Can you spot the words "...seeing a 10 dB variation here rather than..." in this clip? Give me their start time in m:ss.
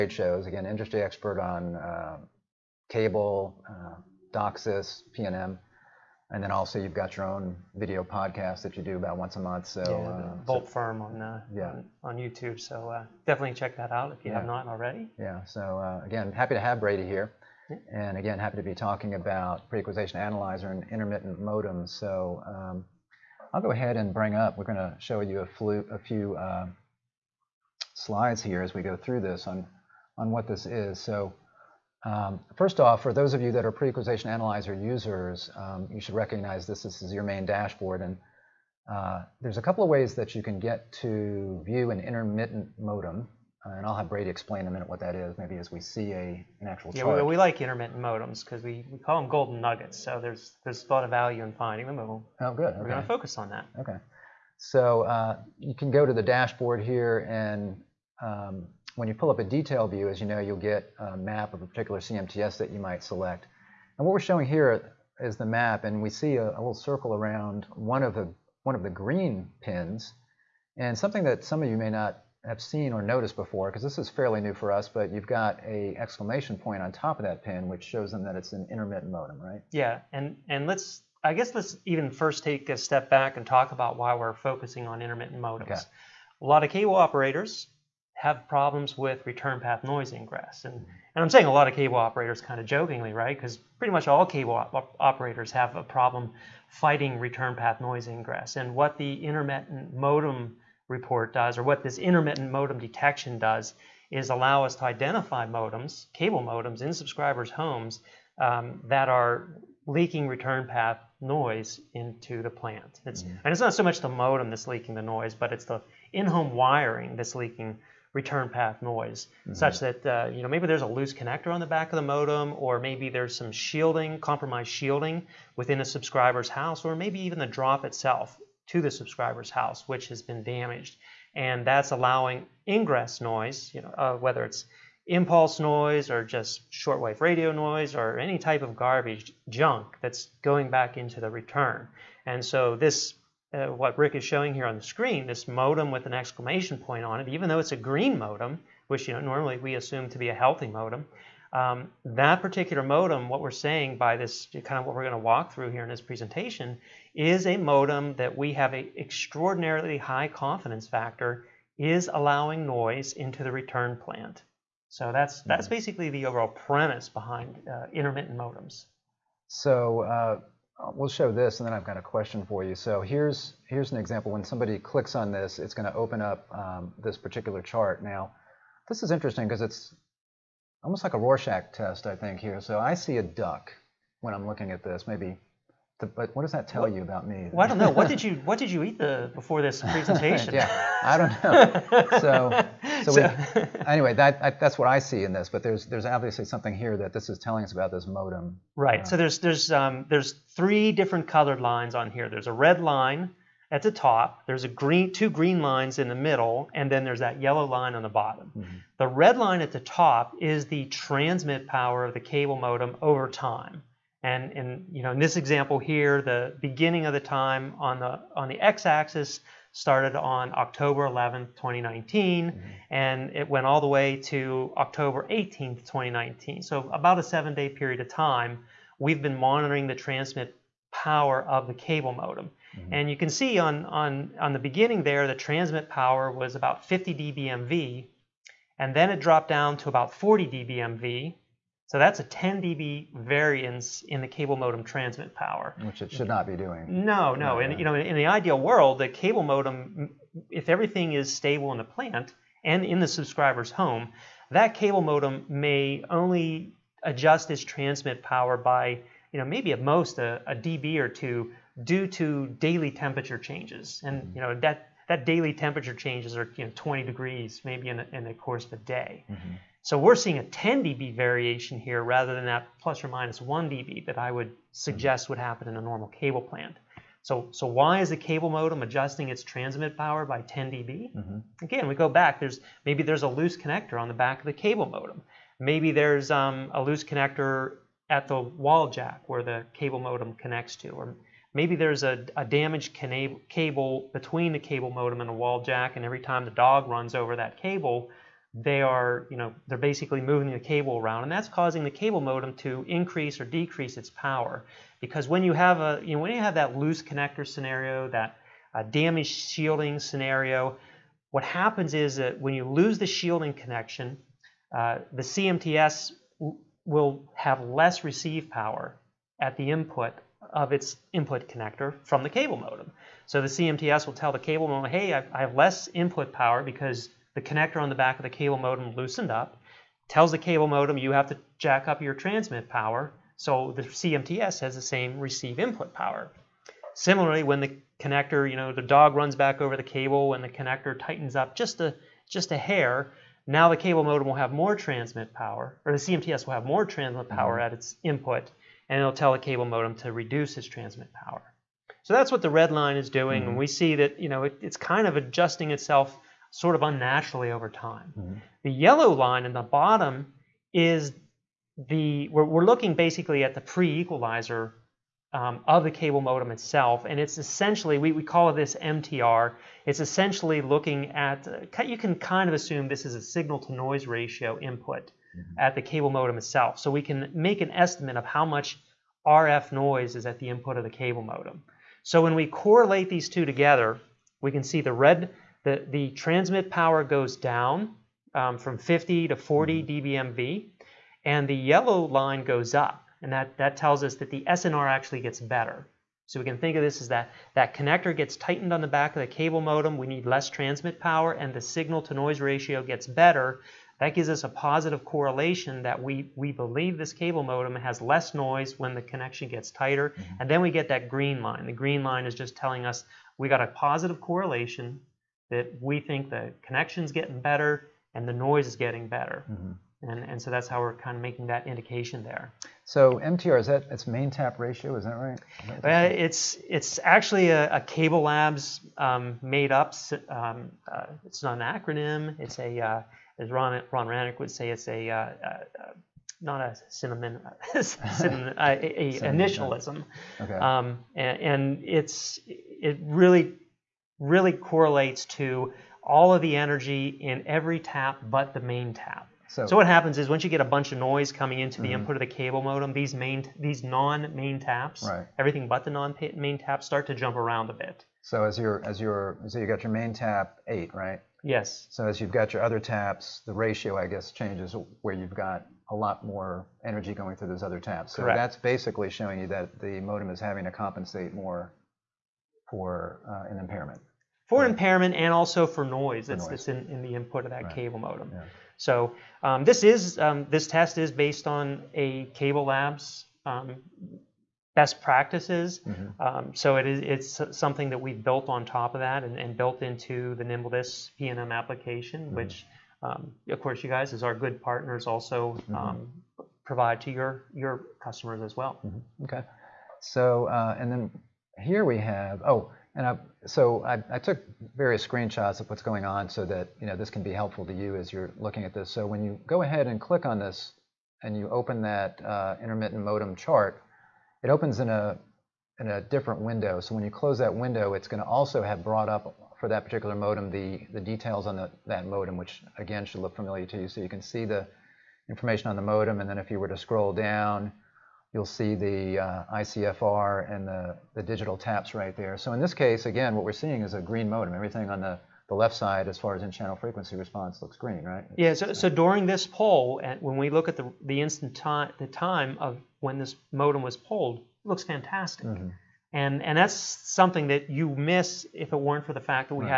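4:30.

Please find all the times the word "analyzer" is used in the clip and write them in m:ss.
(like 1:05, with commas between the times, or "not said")
0:20, 0:34.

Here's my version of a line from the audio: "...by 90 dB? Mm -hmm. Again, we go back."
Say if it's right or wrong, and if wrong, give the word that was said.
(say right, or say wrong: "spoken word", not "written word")
wrong: "10", not "90".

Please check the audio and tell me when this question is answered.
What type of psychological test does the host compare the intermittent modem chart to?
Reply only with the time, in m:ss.
3:01.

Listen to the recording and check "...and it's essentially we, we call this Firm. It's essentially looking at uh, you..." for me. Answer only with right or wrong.
wrong.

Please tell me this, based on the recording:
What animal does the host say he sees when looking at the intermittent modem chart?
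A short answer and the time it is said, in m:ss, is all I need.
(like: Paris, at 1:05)
a duck, at 3:03.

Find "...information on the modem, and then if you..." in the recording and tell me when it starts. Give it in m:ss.
8:45.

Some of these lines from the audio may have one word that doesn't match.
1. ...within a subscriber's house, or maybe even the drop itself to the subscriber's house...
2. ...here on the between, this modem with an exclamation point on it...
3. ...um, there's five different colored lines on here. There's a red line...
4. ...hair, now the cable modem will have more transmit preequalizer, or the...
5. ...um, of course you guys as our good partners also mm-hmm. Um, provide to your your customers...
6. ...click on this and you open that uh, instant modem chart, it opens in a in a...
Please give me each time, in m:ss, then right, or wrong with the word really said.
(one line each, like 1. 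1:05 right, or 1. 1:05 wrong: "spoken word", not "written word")
1. 2:05 right
2. 2:24 wrong: "screen", not "between"
3. 3:19 wrong: "three", not "five"
4. 5:42 wrong: "power", not "preequalizer"
5. 8:13 right
6. 8:29 wrong: "intermittent", not "instant".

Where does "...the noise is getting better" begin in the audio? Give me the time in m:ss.
6:58.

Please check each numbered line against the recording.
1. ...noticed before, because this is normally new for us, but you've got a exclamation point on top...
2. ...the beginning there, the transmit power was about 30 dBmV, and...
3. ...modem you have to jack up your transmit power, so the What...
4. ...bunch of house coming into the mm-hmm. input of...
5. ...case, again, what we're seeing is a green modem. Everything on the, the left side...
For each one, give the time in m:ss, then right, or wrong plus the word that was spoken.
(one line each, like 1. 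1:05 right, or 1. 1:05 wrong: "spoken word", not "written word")
1. 1:13 wrong: "fairly", not "normally"
2. 3:54 wrong: "50", not "30"
3. 5:30 wrong: "CMTS", not "What"
4. 7:30 wrong: "noise", not "house"
5. 8:52 right.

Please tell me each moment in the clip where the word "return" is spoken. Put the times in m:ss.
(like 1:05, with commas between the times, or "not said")
1:29, 1:37, 1:50, 1:58, 2:21, 2:43.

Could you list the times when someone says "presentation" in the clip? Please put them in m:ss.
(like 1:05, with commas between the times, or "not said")
2:36, 3:09.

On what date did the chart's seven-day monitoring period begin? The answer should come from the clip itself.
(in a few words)
October 11, 2019.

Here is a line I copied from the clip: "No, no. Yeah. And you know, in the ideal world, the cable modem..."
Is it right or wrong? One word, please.
right.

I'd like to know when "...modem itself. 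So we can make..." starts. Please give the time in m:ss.
6:16.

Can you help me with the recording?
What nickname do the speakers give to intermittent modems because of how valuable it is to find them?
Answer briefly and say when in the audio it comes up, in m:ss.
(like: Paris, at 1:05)
golden nuggets, at 0:49.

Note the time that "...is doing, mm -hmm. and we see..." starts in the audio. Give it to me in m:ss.
5:52.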